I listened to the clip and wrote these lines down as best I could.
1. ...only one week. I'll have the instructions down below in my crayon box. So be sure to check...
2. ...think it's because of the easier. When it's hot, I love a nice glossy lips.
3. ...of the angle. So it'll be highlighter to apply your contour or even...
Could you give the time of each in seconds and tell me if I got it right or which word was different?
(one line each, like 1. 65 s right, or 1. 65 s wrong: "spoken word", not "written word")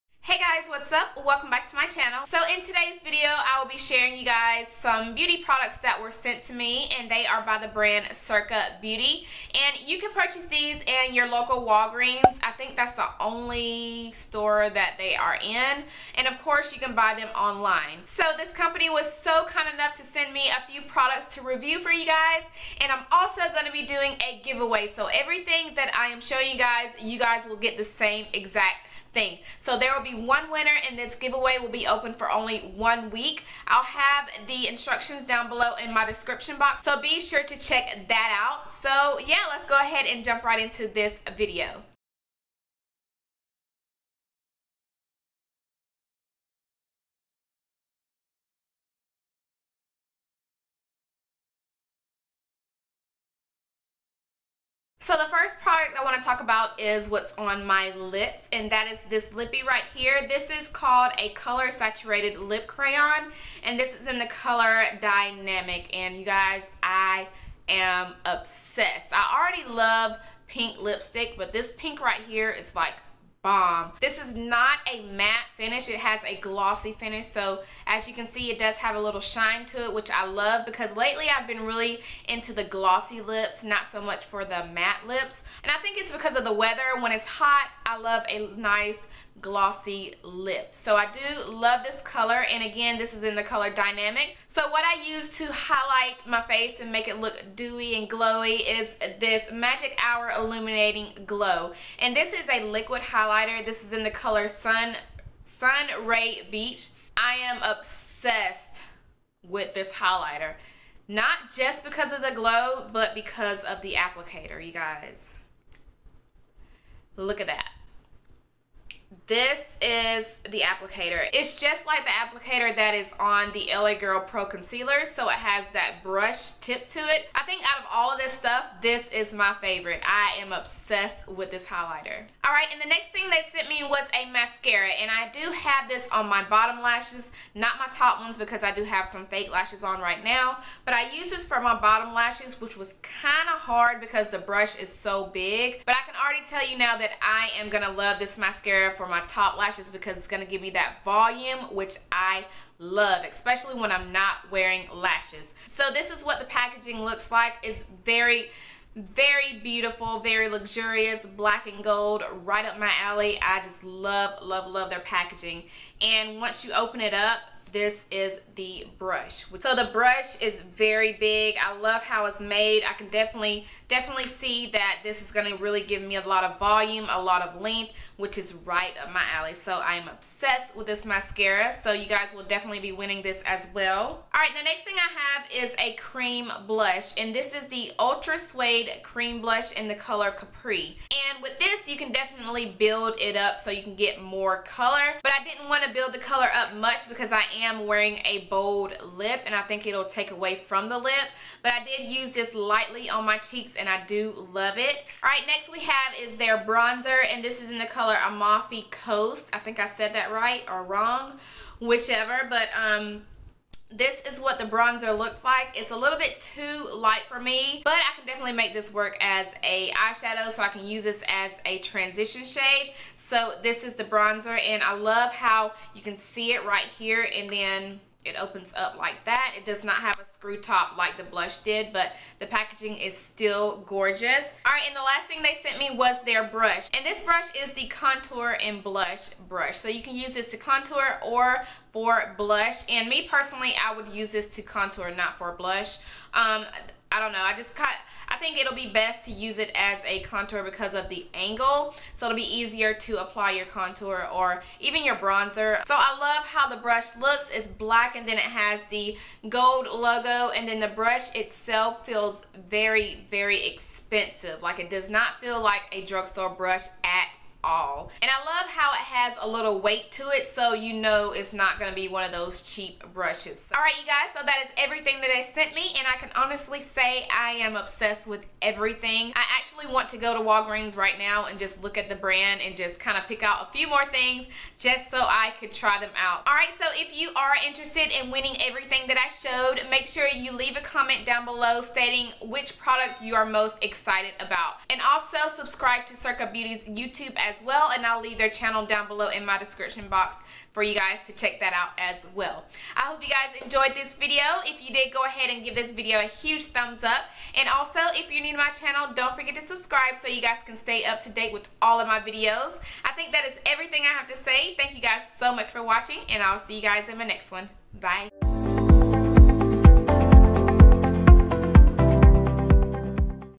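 1. 32 s wrong: "description", not "crayon"
2. 85 s wrong: "weather", not "easier"
3. 250 s wrong: "easier", not "highlighter".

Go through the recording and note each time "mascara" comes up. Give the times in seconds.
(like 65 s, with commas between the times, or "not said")
134 s, 148 s, 181 s.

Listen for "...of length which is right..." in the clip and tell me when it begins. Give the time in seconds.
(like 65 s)
177 s.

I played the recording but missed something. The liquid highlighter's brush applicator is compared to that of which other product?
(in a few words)
LA Girl Pro Concealer.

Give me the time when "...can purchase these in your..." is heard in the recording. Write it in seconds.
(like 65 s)
9 s.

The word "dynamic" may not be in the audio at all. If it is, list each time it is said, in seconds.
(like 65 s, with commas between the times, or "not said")
65 s, 93 s.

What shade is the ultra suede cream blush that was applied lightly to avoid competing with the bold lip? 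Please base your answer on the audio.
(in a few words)
Capri.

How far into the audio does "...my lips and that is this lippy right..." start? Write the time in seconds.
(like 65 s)
57 s.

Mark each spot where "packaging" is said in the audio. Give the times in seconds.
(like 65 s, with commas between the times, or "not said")
156 s, 164 s, 232 s.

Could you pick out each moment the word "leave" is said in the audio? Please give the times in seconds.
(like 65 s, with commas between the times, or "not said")
290 s, 298 s.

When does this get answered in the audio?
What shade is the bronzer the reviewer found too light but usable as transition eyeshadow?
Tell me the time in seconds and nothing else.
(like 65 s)
208 s.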